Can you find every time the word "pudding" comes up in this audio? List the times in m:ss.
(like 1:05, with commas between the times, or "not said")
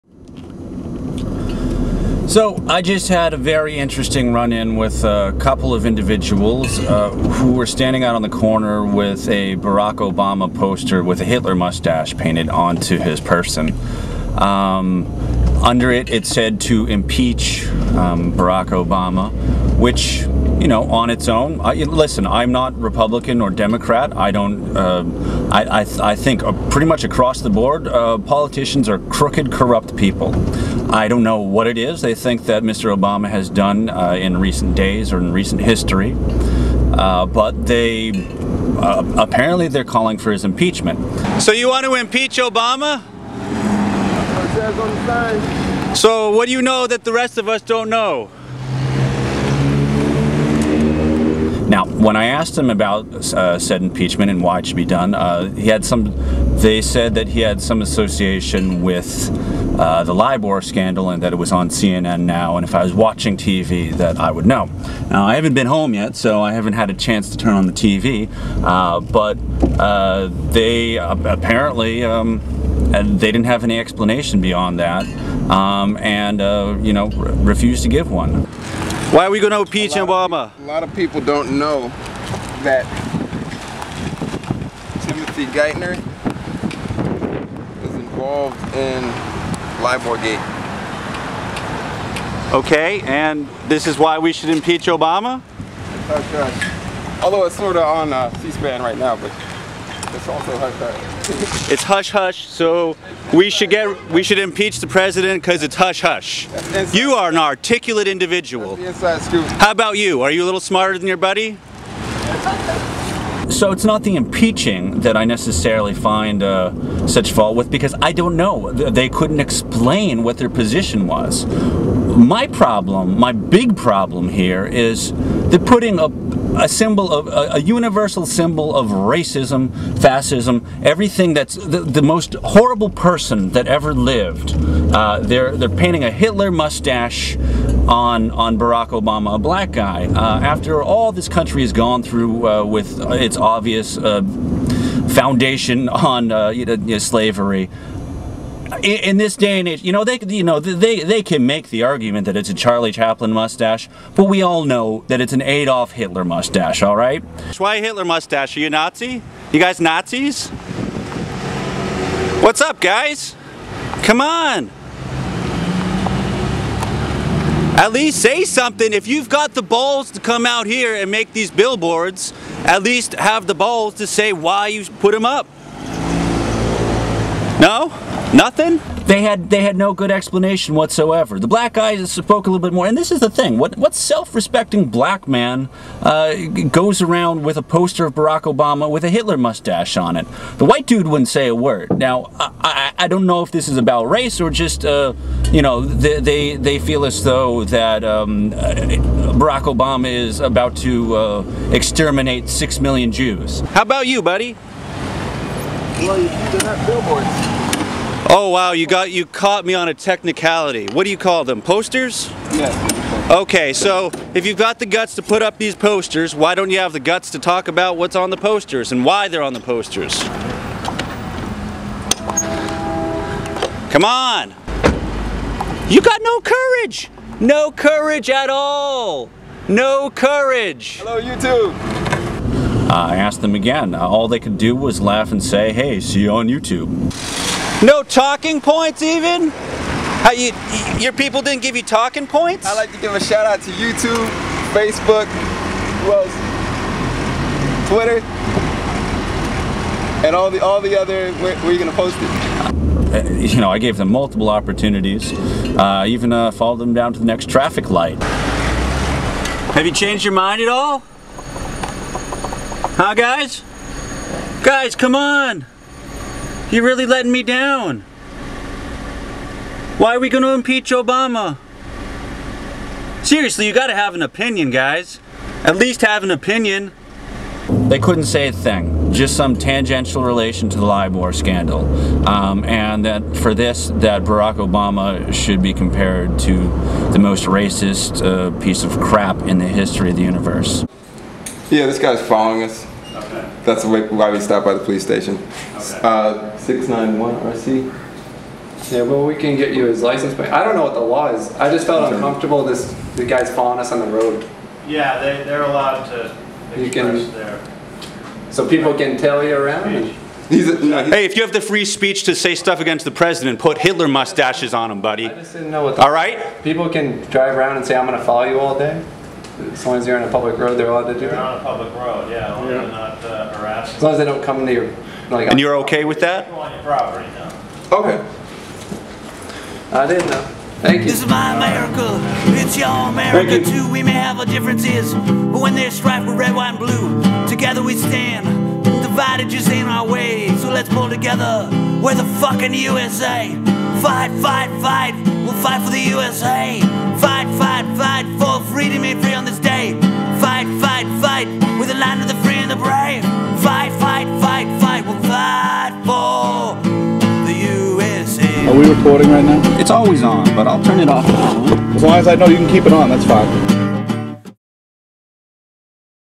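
not said.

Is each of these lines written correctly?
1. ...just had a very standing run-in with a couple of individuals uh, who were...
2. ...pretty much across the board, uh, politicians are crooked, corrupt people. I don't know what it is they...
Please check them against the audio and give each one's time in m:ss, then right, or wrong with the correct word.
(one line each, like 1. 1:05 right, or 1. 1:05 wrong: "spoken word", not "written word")
1. 0:02 wrong: "interesting", not "standing"
2. 0:26 right.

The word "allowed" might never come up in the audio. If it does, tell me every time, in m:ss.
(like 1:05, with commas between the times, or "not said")
5:05, 5:20.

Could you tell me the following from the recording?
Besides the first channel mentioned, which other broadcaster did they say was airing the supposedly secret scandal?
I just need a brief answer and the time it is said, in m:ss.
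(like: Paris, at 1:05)
C-SPAN, at 1:38.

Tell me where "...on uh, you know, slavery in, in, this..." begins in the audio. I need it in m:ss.
2:25.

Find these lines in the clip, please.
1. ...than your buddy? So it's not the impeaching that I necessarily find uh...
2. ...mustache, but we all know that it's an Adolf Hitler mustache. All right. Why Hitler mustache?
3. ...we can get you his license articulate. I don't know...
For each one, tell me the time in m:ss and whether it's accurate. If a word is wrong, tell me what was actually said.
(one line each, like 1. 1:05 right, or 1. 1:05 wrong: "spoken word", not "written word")
1. 1:50 right
2. 2:33 right
3. 4:59 wrong: "plate", not "articulate".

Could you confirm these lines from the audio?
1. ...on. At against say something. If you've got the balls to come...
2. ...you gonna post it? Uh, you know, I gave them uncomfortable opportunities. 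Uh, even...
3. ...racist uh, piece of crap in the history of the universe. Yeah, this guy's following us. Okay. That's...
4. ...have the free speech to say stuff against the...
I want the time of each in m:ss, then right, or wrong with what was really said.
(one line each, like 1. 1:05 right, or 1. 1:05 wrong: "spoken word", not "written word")
1. 2:44 wrong: "least", not "against"
2. 4:11 wrong: "multiple", not "uncomfortable"
3. 4:47 right
4. 5:11 right.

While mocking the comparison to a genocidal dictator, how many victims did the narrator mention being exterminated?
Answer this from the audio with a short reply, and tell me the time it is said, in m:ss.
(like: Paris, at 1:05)
6 million, at 3:22.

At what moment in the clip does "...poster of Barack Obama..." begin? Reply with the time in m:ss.
3:07.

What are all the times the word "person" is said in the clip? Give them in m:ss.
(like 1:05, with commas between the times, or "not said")
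0:13, 2:12.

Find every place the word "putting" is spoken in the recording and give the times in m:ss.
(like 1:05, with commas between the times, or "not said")
2:05.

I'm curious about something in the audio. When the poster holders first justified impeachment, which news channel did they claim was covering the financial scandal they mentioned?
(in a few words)
CNN.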